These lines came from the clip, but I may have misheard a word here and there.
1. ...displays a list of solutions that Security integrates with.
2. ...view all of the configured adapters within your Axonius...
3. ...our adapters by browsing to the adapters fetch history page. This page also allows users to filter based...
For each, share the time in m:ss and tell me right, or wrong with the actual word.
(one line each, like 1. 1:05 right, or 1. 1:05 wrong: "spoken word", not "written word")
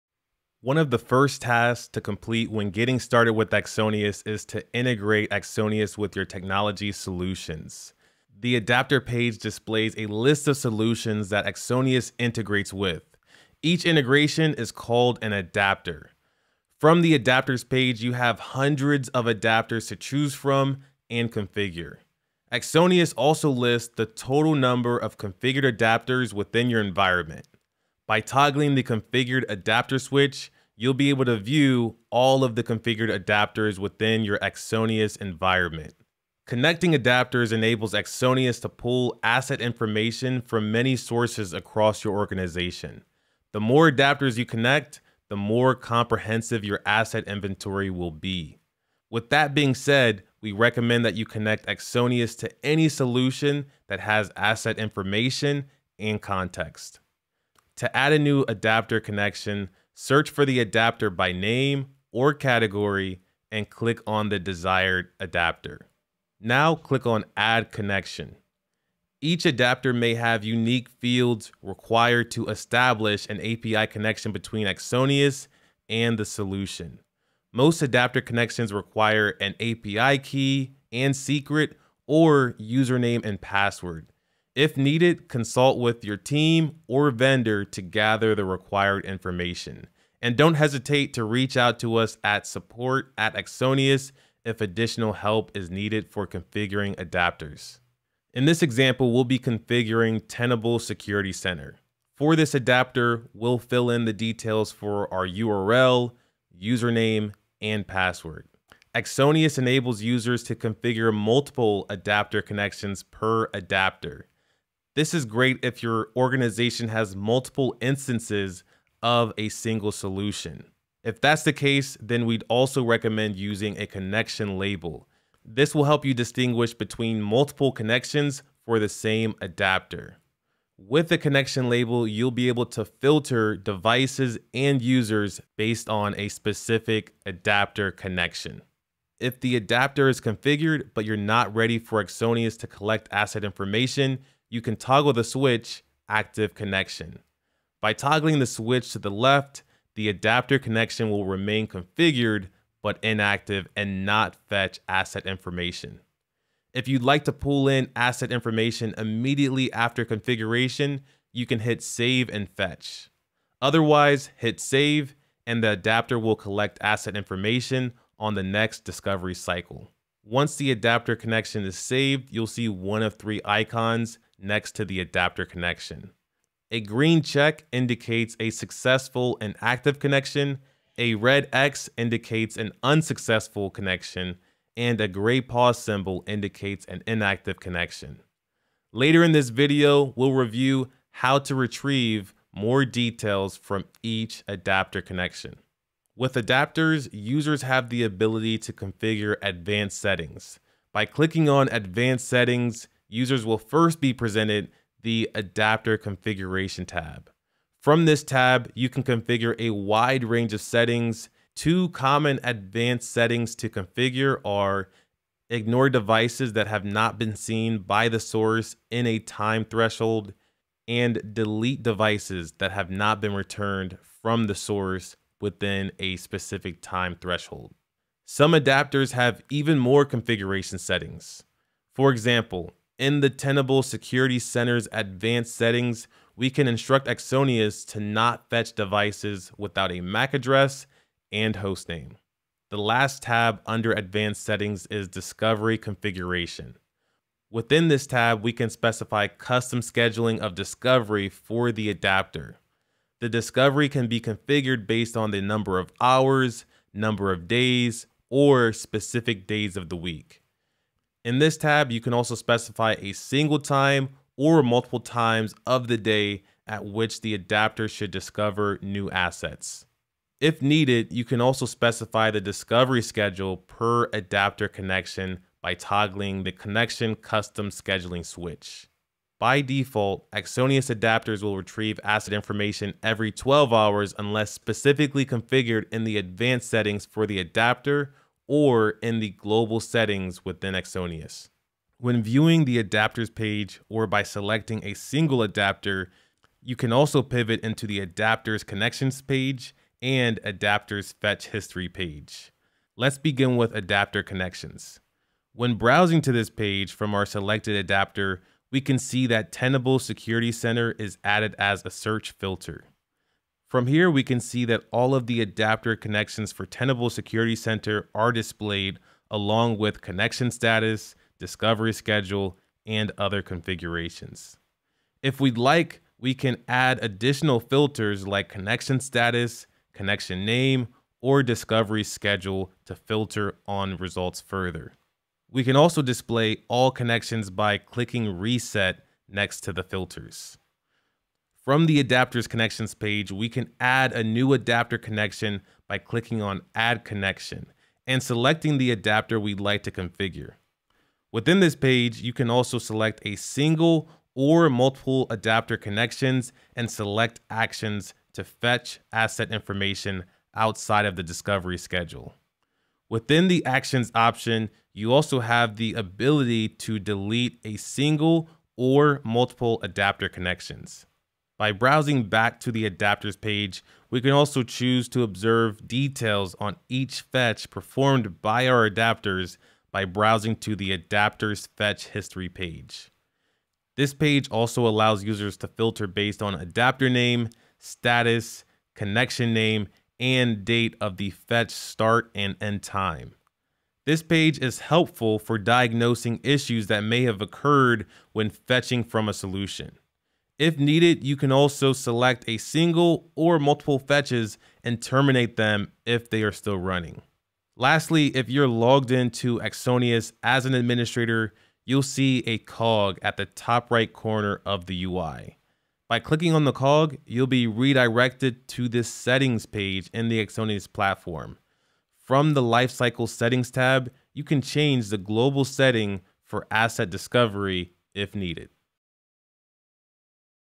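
1. 0:09 wrong: "Axonius", not "Security"
2. 0:31 right
3. 6:18 right.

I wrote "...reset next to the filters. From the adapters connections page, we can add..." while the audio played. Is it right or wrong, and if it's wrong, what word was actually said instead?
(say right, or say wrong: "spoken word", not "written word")
right.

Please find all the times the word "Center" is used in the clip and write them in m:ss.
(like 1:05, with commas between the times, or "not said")
1:41, 3:54, 5:10, 5:17.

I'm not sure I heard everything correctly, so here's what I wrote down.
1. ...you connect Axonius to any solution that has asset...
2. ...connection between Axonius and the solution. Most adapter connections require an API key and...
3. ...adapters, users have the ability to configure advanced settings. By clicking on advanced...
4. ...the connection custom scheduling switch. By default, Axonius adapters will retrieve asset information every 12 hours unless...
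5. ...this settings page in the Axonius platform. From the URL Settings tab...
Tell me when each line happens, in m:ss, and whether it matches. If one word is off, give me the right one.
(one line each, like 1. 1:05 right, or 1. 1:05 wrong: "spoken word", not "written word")
1. 0:51 right
2. 1:13 right
3. 3:16 right
4. 4:36 right
5. 6:58 wrong: "Lifecycle", not "URL".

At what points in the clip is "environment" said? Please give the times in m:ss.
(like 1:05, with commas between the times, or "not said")
0:26, 0:35.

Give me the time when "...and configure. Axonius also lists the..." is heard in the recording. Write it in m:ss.
0:21.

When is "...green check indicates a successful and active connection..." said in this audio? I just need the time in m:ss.
2:56.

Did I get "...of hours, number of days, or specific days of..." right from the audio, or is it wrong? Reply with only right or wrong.
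right.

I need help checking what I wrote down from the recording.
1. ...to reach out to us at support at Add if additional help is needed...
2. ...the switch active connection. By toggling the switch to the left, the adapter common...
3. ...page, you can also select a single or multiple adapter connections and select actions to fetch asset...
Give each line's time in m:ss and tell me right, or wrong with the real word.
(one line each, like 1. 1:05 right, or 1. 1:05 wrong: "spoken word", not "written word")
1. 1:31 wrong: "Axonius", not "Add"
2. 2:25 wrong: "connection", not "common"
3. 5:51 right.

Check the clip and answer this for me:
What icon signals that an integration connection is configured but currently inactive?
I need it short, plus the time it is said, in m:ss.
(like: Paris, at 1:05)
gray pause symbol, at 3:05.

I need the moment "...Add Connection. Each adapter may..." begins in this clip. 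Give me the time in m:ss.
1:07.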